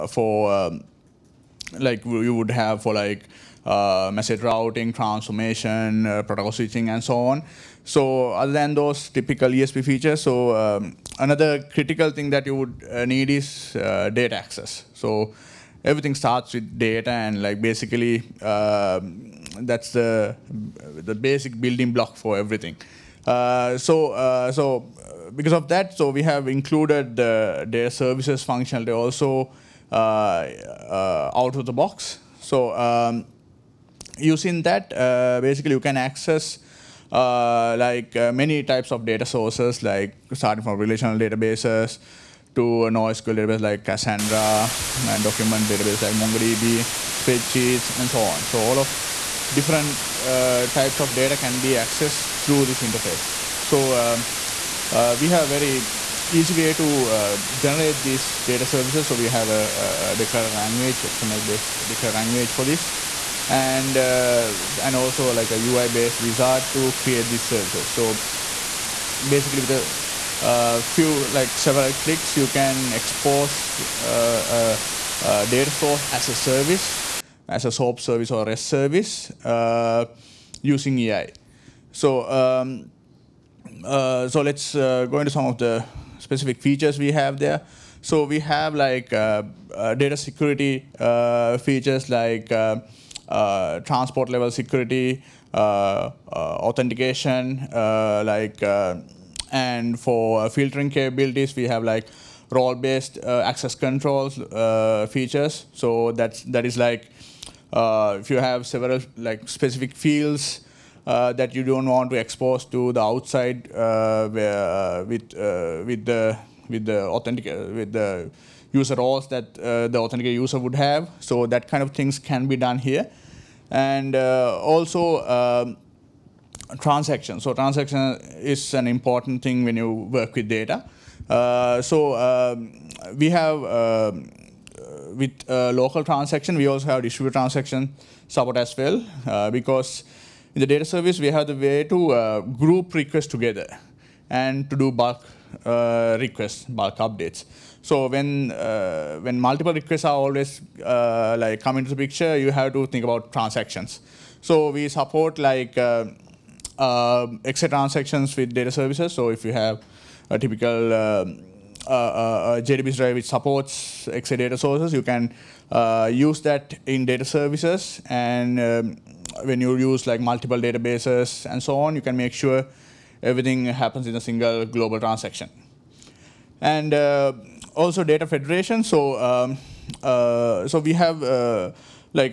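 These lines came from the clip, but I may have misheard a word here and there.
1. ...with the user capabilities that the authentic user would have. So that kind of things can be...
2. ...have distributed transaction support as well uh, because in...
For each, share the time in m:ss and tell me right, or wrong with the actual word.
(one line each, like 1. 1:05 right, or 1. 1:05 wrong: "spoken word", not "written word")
1. 1:57 wrong: "roles", not "capabilities"
2. 2:16 right.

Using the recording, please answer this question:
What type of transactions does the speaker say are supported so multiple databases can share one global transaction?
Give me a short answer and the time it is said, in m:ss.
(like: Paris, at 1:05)
XA transactions, at 2:37.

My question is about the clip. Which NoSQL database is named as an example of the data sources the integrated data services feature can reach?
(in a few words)
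Cassandra.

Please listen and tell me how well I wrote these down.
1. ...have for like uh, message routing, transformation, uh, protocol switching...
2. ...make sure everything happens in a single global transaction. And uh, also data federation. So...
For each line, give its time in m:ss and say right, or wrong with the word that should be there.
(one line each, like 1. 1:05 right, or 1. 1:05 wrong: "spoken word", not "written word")
1. 0:02 right
2. 2:52 right.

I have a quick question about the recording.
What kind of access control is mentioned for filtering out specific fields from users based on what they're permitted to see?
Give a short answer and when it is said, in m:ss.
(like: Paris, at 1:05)
role-based access controls, at 1:42.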